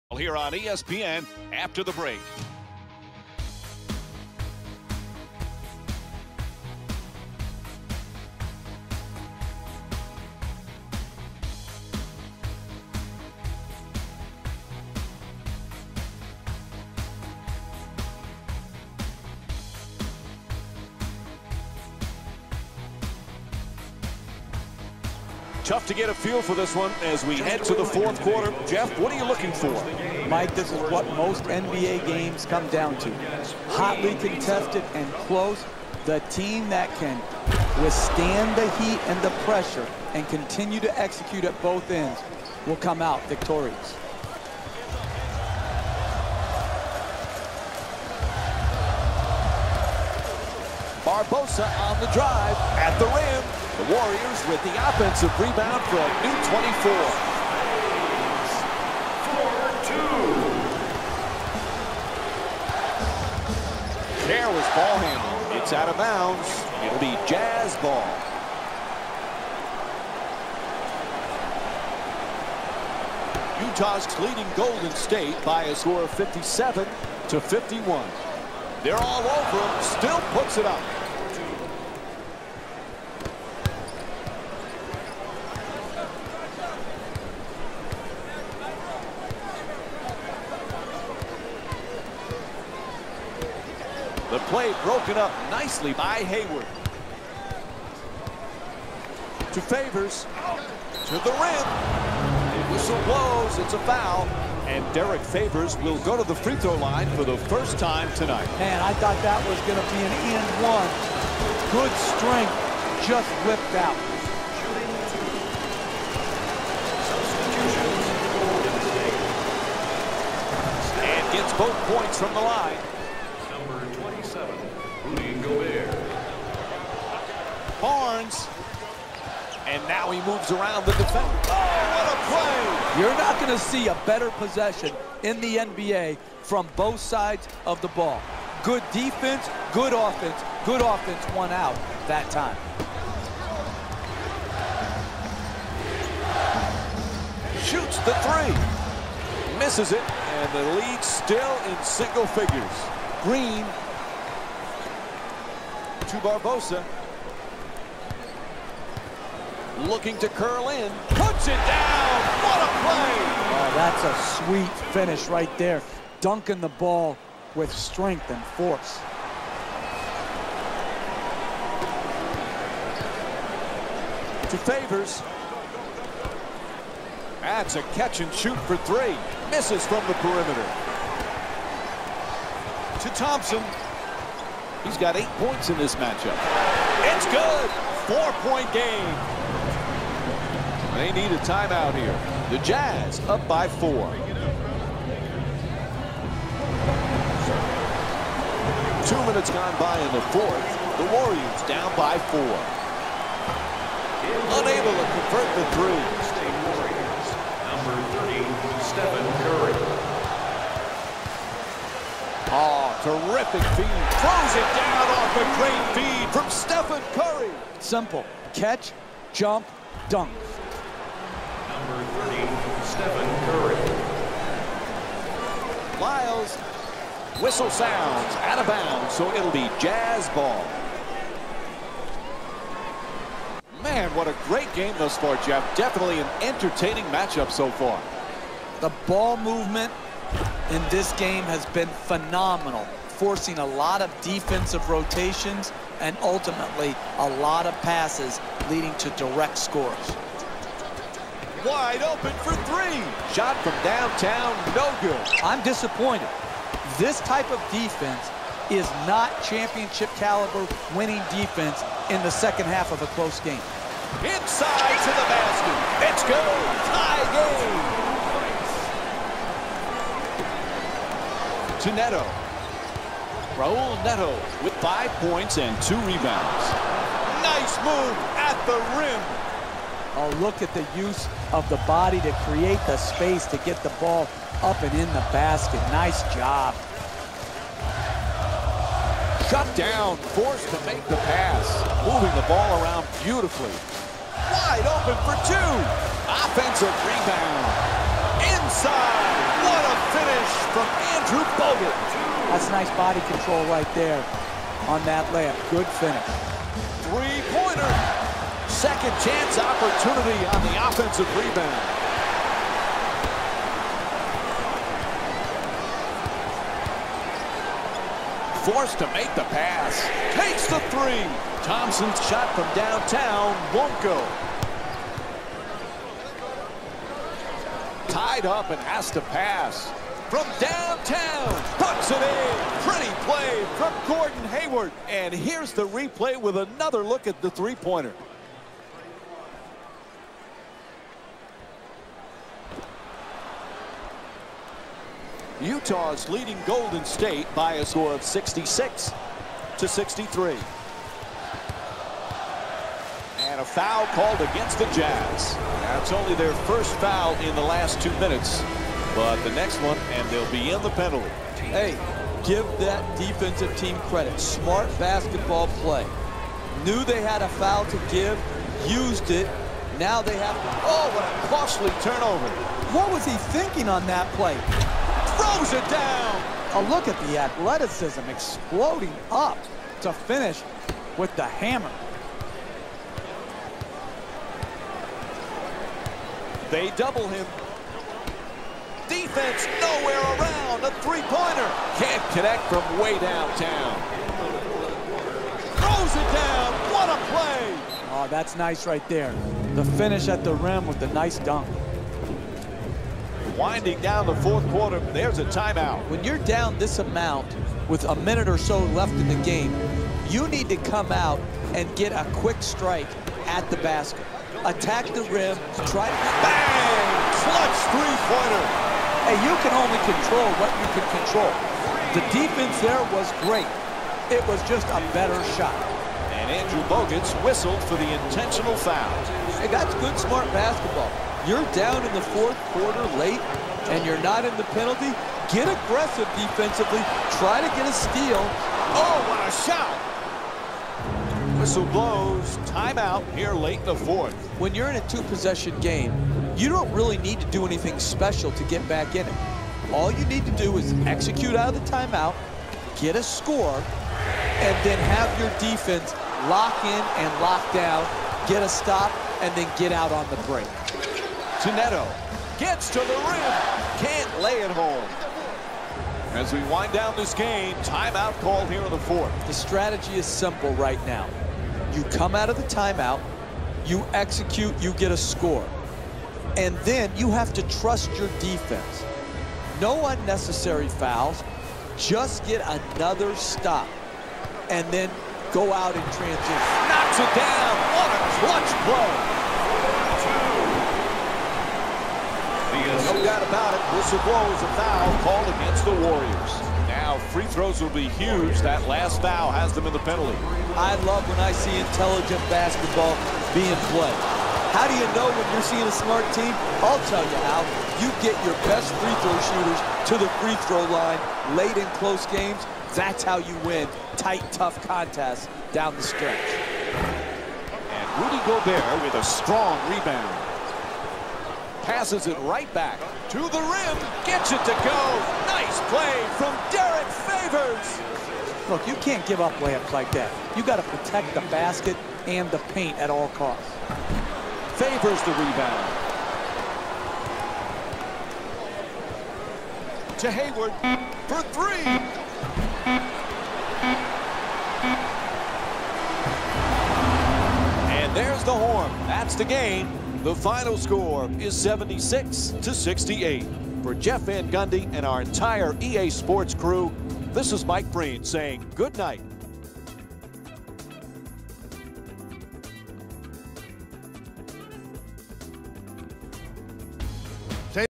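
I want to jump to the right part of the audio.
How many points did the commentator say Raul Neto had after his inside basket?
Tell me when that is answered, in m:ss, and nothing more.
4:34.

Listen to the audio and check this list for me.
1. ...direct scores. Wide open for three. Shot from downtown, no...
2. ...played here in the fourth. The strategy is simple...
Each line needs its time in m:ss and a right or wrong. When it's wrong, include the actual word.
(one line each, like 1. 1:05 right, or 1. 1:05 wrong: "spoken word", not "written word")
1. 4:09 right
2. 7:48 wrong: "called", not "played".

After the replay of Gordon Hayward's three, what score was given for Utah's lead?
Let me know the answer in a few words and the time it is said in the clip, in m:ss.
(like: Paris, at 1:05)
66 to 63, at 5:48.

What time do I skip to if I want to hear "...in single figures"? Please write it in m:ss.
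2:31.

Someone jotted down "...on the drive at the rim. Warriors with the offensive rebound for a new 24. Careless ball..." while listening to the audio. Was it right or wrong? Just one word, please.
right.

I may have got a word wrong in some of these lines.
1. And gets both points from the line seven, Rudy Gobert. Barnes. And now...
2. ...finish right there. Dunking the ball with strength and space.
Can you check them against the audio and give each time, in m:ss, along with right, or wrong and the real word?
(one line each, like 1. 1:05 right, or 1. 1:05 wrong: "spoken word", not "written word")
1. 2:01 right
2. 2:44 wrong: "force", not "space".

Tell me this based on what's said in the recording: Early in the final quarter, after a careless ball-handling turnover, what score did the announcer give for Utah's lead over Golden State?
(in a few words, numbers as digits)
57 to 51.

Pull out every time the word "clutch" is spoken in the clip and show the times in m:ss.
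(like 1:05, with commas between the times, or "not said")
6:57, 8:08.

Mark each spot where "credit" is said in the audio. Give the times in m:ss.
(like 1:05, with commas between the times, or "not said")
6:04.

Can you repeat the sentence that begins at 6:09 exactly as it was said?
Now they have, oh, what a costly turnover.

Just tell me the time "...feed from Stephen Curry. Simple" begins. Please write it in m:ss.
3:36.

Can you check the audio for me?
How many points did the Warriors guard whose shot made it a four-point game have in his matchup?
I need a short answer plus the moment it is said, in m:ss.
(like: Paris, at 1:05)
8, at 3:05.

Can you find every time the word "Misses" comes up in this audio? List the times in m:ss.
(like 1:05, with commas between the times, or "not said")
2:29, 2:59.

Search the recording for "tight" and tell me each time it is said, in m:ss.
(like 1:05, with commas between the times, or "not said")
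8:34.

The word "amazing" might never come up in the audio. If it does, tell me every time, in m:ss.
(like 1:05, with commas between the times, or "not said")
not said.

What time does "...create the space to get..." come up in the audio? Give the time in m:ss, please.
4:42.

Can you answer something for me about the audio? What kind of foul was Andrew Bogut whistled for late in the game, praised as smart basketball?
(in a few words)
intentional foul.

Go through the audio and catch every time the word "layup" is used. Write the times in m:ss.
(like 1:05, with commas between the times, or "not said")
5:05, 8:49.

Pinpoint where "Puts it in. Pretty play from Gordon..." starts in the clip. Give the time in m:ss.
5:31.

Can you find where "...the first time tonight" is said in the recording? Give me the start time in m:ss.
1:47.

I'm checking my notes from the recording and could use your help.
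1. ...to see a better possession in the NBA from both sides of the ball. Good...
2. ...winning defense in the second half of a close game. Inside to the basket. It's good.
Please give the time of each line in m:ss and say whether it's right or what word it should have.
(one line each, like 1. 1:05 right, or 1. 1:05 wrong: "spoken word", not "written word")
1. 2:13 right
2. 4:20 right.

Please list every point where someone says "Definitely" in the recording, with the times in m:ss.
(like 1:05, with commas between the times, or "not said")
3:55.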